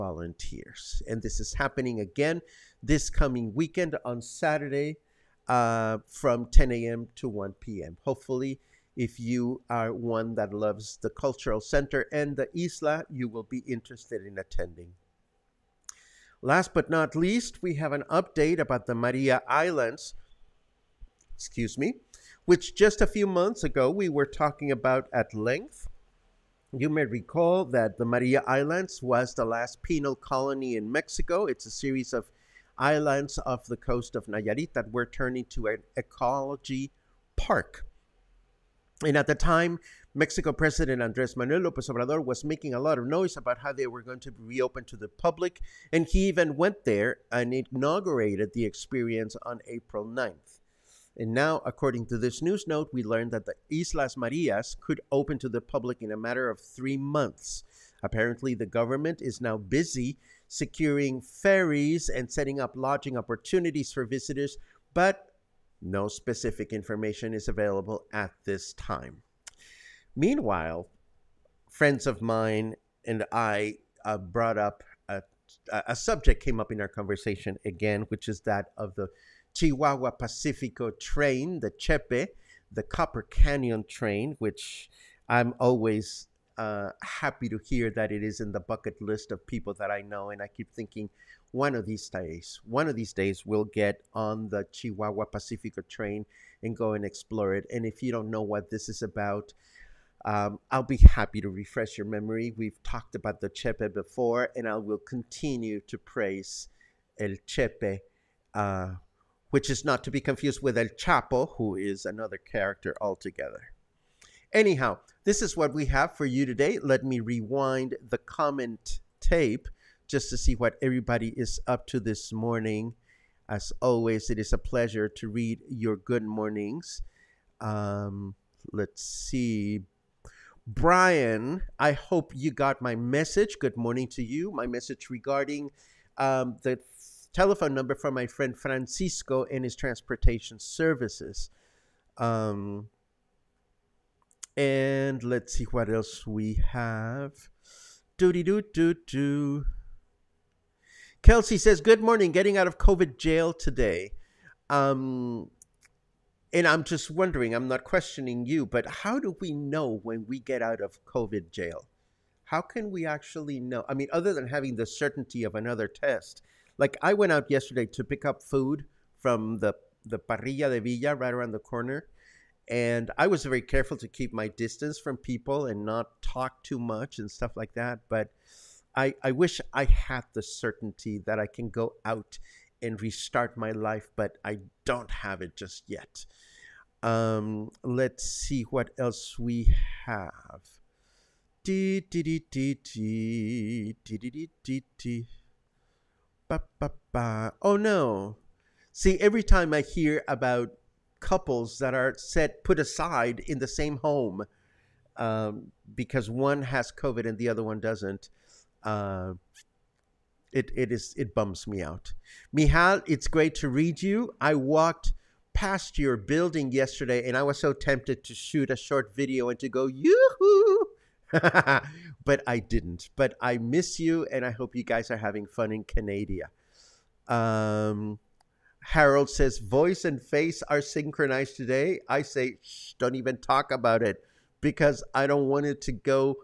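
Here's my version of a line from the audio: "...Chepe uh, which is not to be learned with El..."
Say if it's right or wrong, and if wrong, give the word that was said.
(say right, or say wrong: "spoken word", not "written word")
wrong: "confused", not "learned".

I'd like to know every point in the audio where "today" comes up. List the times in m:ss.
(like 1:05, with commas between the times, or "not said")
1:56, 2:33, 3:51.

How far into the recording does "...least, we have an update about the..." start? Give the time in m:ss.
0:17.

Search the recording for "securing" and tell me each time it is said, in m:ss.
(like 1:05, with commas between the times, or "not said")
1:00.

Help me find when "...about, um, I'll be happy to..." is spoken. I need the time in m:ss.
1:39.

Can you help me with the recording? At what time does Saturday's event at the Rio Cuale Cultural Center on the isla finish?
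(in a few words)
1 p.m.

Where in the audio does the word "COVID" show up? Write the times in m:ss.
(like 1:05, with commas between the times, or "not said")
2:32, 2:41, 3:26.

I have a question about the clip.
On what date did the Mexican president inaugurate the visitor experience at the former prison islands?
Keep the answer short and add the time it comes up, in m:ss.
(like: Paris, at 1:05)
April 9th, at 0:49.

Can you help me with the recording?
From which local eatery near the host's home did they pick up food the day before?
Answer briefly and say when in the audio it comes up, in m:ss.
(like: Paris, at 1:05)
parrilla de Villa, at 2:50.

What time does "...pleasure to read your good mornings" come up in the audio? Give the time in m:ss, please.
2:04.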